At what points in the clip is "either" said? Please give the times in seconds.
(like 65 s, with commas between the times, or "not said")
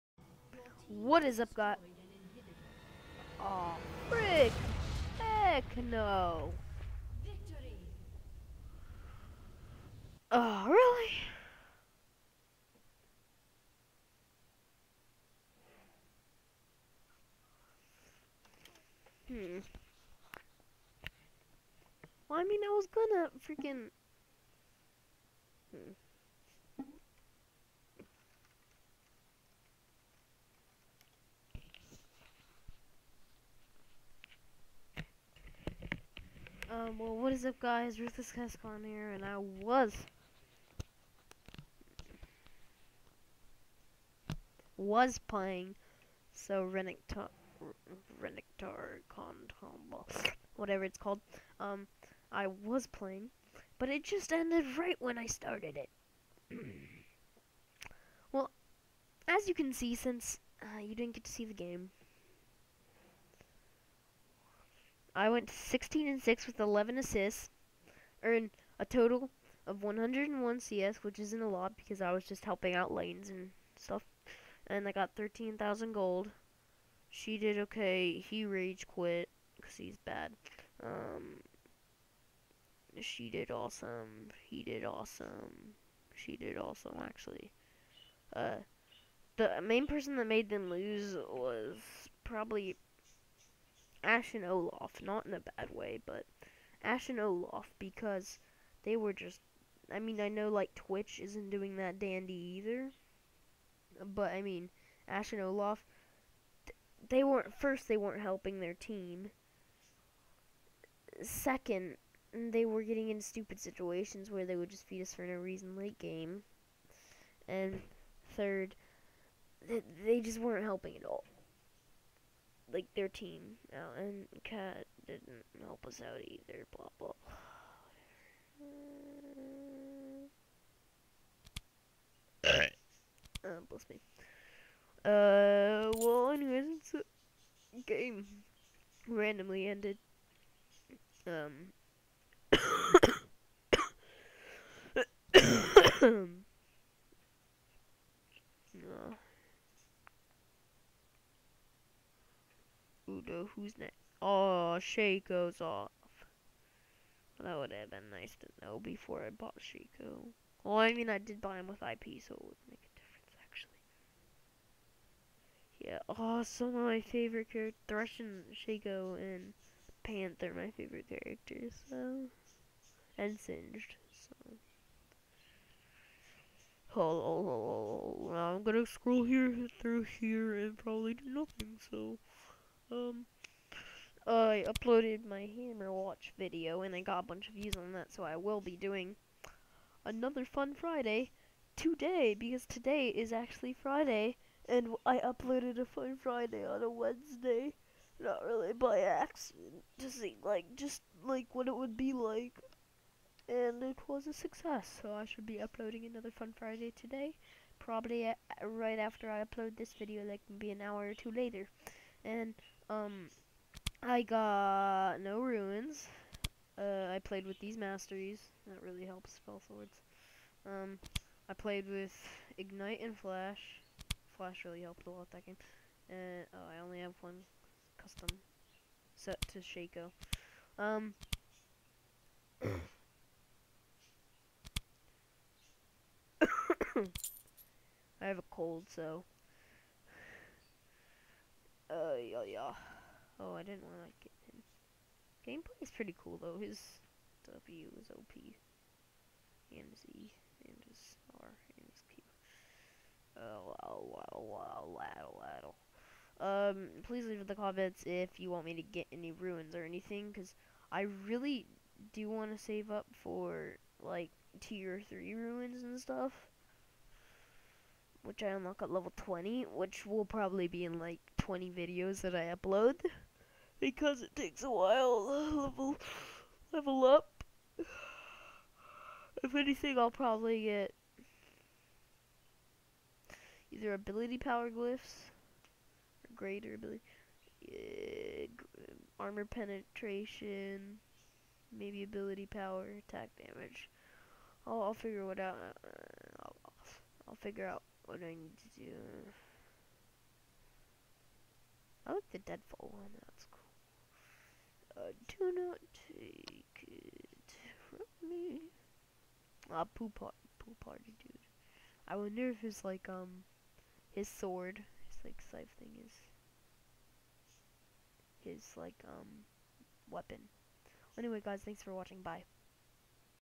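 102 s, 126 s, 283 s.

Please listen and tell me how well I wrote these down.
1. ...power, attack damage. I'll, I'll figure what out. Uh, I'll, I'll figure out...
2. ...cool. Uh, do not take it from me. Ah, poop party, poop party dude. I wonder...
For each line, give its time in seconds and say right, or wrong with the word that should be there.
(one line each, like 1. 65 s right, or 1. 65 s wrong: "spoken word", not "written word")
1. 292 s right
2. 303 s right.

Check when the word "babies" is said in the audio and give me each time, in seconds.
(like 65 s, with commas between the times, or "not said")
not said.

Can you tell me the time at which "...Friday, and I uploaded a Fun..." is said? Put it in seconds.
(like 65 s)
193 s.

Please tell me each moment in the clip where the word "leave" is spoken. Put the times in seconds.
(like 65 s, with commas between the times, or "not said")
257 s.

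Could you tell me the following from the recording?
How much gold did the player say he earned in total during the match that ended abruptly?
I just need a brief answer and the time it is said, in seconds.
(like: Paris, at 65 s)
13,000, at 75 s.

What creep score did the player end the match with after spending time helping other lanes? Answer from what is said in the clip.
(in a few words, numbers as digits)
101.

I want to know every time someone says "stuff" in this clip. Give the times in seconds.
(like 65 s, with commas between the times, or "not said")
73 s, 265 s.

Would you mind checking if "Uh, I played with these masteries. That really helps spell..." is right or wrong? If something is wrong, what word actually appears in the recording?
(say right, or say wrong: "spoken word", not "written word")
right.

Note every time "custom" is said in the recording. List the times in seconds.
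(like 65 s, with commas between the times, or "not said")
227 s.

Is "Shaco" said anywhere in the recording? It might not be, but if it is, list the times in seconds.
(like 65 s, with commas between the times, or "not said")
154 s, 159 s, 168 s, 229 s.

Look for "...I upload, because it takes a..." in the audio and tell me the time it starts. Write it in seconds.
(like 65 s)
272 s.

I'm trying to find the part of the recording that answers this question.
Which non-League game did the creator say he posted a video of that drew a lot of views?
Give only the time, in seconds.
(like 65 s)
185 s.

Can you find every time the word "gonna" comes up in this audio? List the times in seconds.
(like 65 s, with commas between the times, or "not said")
22 s, 178 s.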